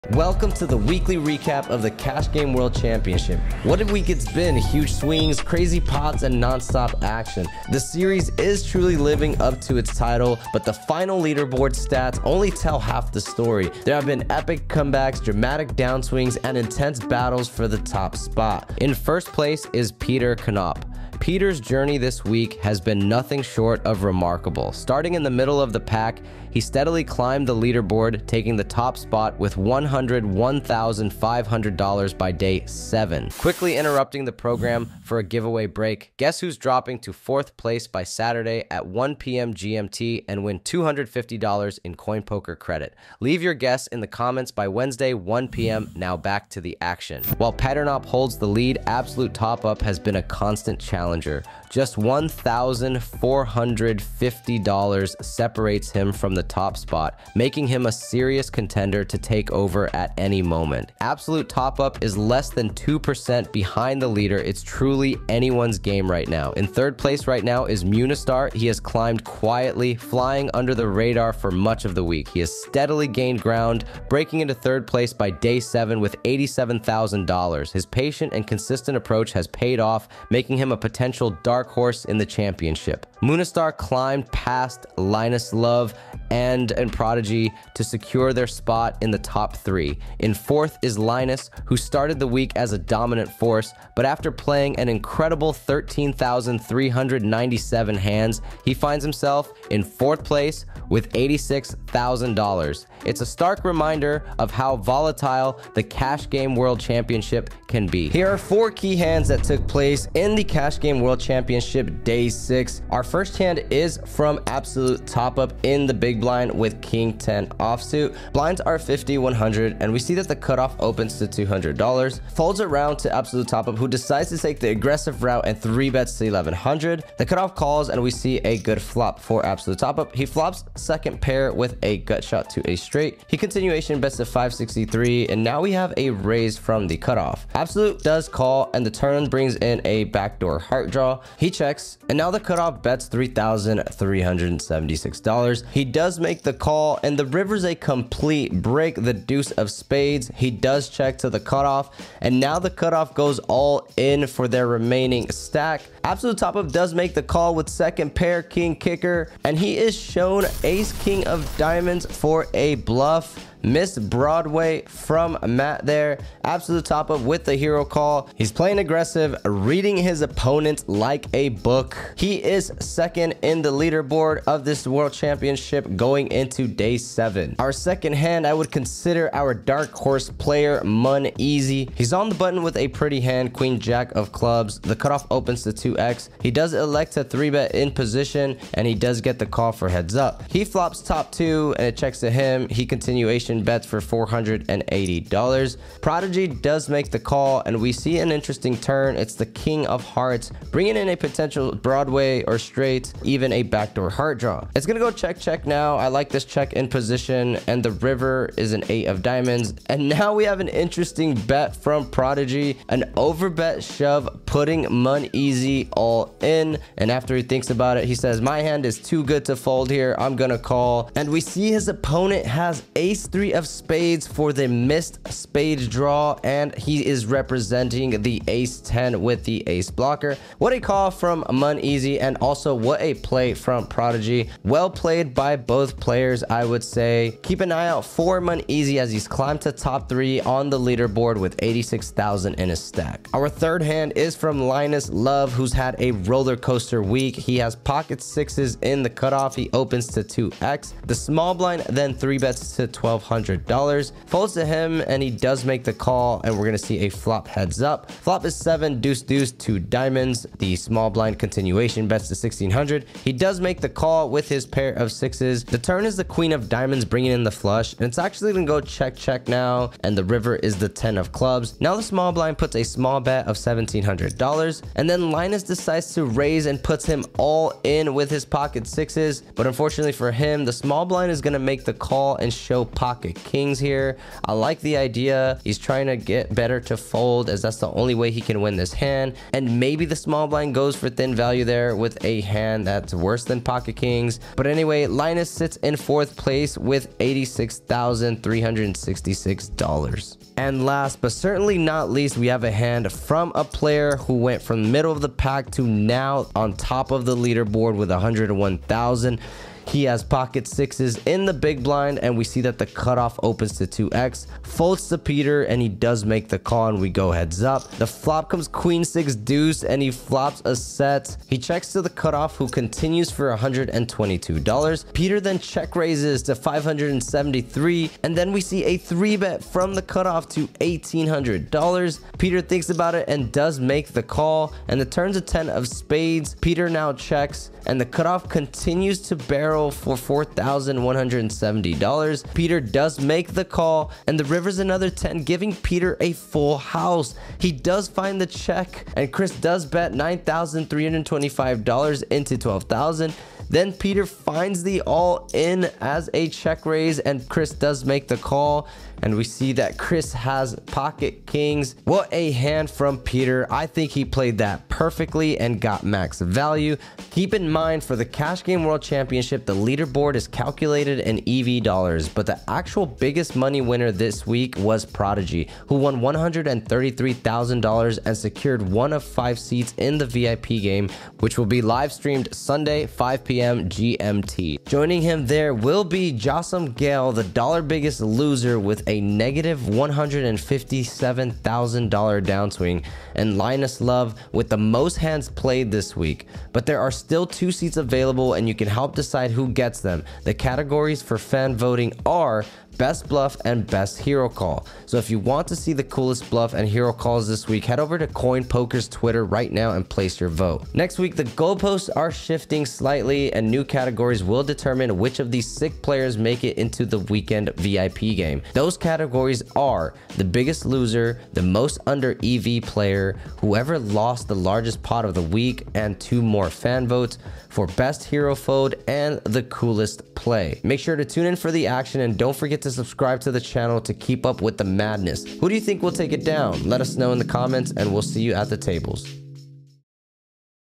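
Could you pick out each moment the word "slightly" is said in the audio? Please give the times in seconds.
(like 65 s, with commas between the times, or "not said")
412 s.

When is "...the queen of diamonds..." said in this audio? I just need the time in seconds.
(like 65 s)
266 s.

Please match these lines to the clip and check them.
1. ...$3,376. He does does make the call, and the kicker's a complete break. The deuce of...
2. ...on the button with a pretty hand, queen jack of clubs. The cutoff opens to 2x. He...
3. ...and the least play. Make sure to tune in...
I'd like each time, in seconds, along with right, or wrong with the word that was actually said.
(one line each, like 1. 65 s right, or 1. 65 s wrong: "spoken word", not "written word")
1. 143 s wrong: "river", not "kicker"
2. 182 s right
3. 429 s wrong: "coolest", not "least".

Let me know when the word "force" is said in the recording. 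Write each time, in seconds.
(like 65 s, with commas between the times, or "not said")
93 s.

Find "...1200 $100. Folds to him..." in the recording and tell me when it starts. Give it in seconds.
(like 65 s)
252 s.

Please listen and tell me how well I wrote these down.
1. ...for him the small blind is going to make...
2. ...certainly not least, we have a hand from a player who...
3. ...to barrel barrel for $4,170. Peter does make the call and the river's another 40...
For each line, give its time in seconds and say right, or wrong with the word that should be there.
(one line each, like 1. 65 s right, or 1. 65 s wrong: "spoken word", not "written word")
1. 280 s right
2. 301 s right
3. 339 s wrong: "10", not "40".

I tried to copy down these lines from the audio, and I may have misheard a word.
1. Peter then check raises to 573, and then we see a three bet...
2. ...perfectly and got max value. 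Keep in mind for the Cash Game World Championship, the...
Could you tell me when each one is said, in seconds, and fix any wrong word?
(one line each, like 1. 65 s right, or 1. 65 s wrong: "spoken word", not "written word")
1. 325 s right
2. 365 s right.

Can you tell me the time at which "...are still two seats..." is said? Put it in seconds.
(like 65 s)
396 s.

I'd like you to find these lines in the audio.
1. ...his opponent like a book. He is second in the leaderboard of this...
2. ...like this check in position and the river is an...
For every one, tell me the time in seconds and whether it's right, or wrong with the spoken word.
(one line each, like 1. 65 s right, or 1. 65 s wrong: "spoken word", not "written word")
1. 169 s right
2. 206 s right.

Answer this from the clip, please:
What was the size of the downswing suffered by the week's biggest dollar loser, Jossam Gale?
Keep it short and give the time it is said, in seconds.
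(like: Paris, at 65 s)
$157,000, at 389 s.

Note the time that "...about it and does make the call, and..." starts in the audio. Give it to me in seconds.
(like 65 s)
332 s.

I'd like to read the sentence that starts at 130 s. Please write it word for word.
He flops second pair with a gut shot to a straight.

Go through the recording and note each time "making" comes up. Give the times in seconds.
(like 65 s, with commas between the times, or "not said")
57 s, 80 s.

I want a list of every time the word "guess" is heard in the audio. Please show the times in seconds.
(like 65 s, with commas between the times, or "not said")
36 s, 43 s.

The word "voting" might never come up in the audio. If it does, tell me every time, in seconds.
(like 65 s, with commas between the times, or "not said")
401 s.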